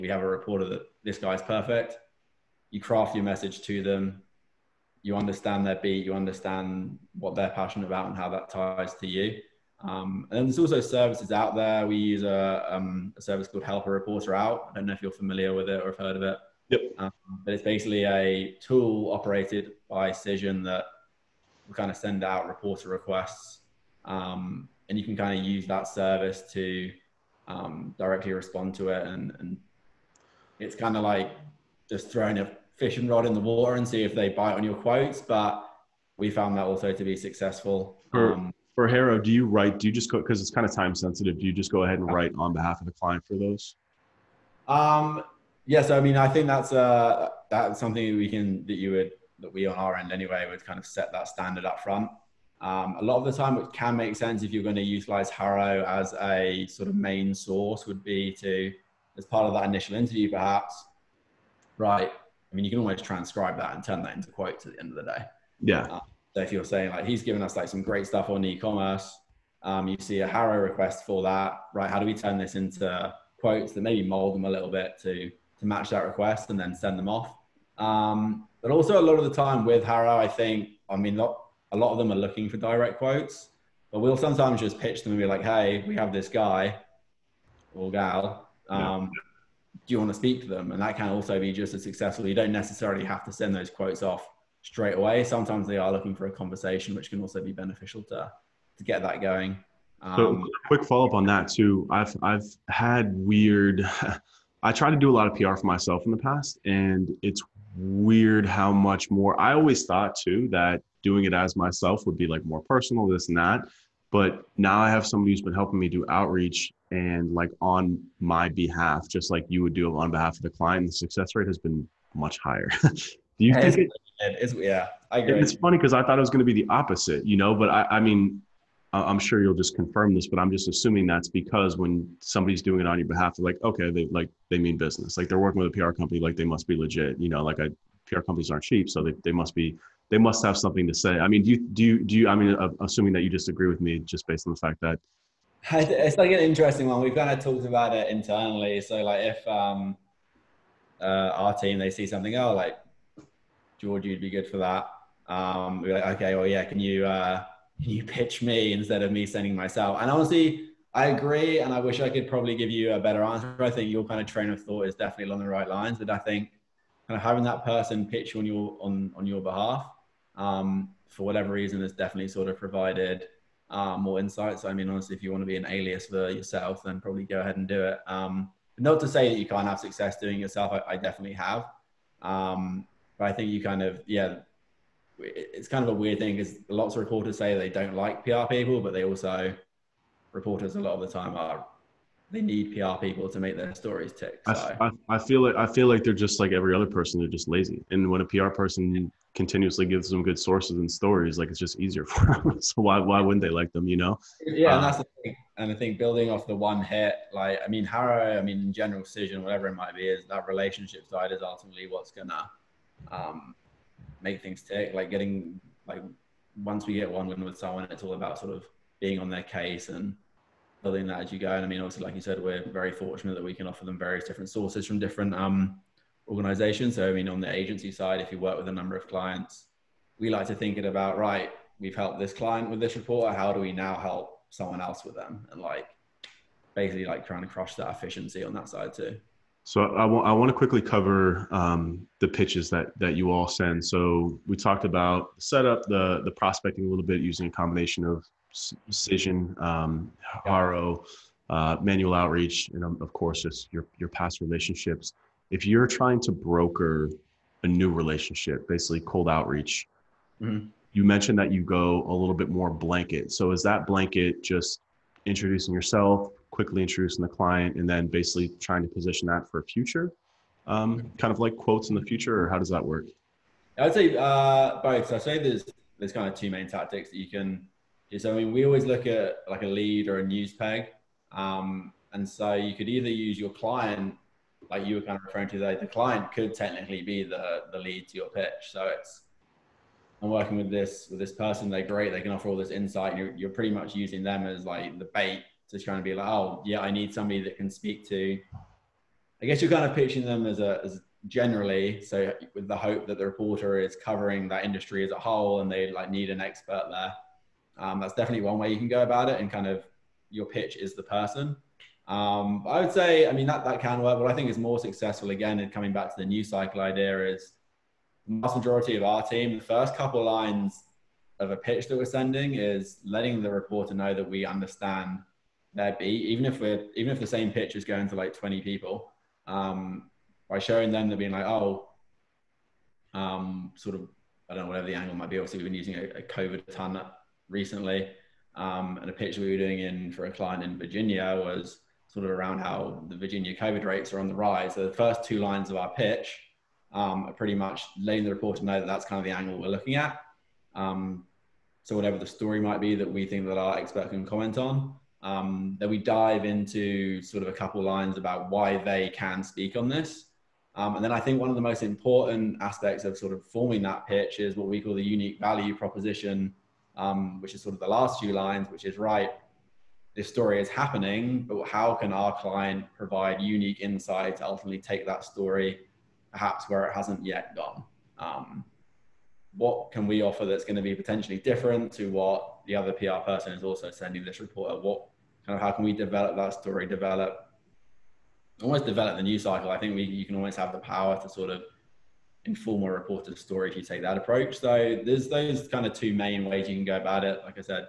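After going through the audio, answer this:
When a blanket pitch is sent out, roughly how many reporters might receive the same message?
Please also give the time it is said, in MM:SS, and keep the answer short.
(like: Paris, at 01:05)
20, at 05:28.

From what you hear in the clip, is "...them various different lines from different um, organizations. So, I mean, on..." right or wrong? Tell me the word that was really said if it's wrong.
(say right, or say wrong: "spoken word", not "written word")
wrong: "sources", not "lines".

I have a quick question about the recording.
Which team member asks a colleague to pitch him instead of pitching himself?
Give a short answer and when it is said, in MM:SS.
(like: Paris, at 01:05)
George, at 02:33.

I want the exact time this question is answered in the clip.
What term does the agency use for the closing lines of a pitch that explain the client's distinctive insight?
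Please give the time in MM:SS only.
06:05.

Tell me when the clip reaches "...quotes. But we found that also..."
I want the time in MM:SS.
00:34.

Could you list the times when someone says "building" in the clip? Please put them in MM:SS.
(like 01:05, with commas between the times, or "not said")
03:25, 03:40.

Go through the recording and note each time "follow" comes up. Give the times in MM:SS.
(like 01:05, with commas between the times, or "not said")
01:40.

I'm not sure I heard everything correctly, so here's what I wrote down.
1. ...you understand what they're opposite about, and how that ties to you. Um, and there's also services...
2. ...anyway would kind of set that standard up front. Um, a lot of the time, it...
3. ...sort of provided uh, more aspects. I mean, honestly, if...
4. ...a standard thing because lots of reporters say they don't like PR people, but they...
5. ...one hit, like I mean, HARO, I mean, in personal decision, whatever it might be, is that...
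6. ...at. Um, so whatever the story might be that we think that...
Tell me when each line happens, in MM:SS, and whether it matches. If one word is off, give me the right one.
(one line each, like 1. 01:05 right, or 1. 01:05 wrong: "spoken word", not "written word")
1. 00:06 wrong: "passionate", not "opposite"
2. 00:50 right
3. 02:52 wrong: "insights", not "aspects"
4. 03:05 wrong: "weird", not "standard"
5. 03:26 wrong: "general", not "personal"
6. 05:49 right.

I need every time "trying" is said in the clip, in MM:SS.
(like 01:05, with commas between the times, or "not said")
03:57, 04:15, 04:28.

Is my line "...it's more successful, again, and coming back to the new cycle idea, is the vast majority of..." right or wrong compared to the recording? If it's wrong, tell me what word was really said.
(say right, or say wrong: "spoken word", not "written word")
right.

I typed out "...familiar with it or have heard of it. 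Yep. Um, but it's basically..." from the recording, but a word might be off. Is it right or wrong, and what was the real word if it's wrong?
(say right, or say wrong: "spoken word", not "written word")
right.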